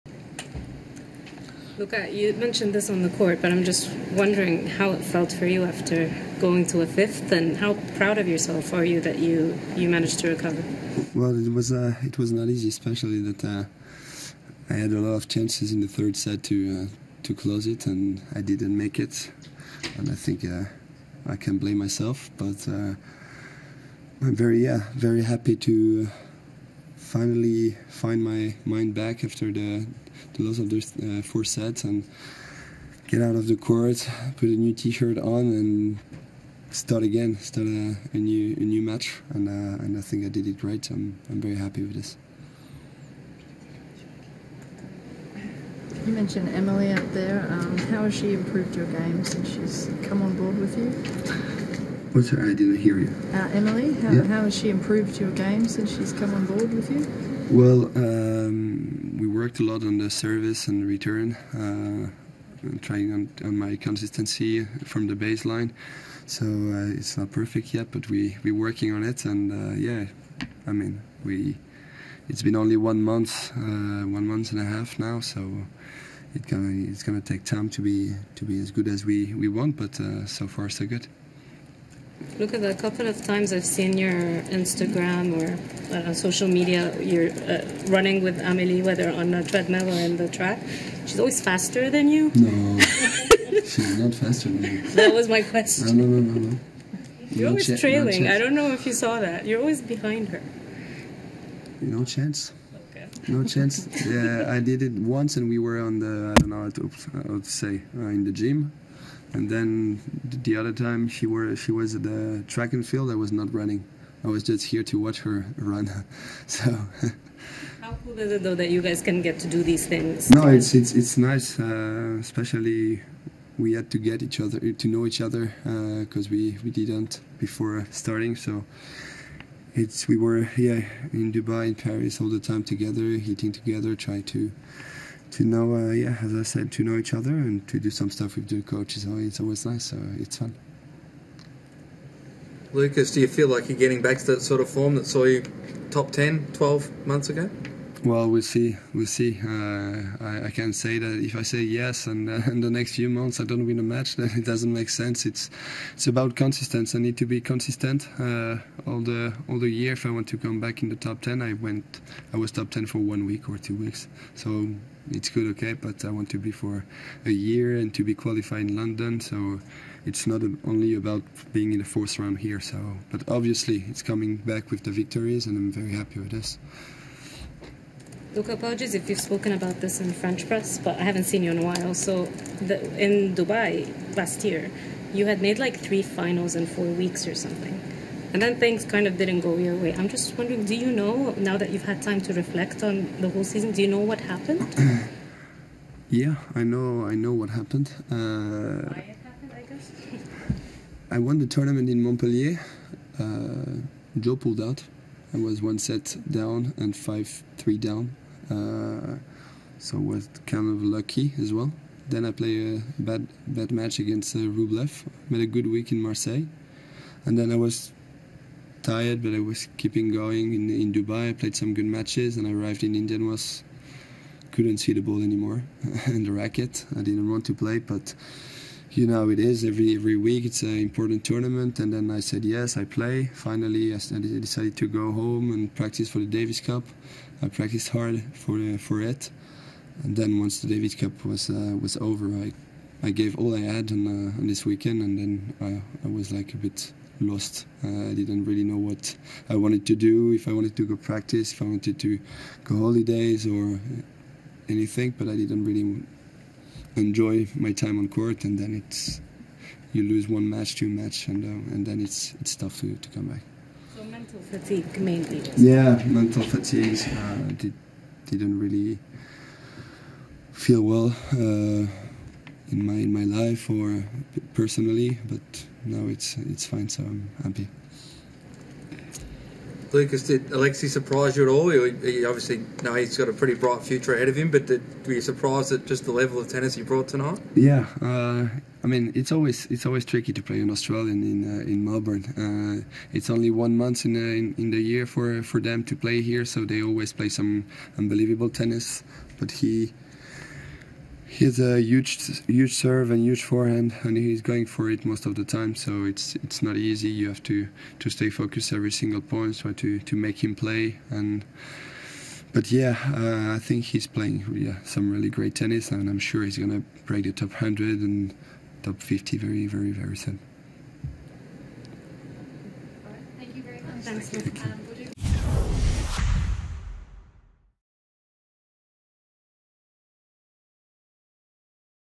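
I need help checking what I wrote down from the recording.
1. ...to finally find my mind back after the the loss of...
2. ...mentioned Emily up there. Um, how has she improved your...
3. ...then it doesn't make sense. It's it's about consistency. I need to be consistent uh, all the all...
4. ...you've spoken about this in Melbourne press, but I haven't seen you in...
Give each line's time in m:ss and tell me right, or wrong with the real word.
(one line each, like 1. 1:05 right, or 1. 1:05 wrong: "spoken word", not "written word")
1. 0:25 right
2. 0:46 right
3. 2:34 right
4. 2:59 wrong: "French", not "Melbourne".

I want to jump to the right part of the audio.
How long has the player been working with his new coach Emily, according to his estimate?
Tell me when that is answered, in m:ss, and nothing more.
1:14.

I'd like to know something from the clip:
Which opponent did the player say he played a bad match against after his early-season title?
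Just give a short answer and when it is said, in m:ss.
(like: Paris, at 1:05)
Rublev, at 3:34.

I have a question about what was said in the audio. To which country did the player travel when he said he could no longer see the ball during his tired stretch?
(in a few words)
India.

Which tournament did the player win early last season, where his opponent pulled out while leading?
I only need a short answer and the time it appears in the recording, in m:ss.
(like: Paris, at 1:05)
Montpellier, at 3:22.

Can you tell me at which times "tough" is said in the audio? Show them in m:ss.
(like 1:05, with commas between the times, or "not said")
4:22.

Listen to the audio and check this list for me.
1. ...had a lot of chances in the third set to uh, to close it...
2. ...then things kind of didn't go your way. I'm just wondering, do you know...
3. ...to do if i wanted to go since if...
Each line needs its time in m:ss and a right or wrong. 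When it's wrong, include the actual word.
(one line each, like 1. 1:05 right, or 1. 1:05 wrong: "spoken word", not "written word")
1. 0:14 right
2. 3:08 right
3. 4:09 wrong: "practice", not "since".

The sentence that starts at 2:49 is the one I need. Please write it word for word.
So it's not only about being in the fourth round here.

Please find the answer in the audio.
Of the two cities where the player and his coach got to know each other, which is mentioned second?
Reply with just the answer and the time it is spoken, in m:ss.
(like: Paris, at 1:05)
Paris, at 2:11.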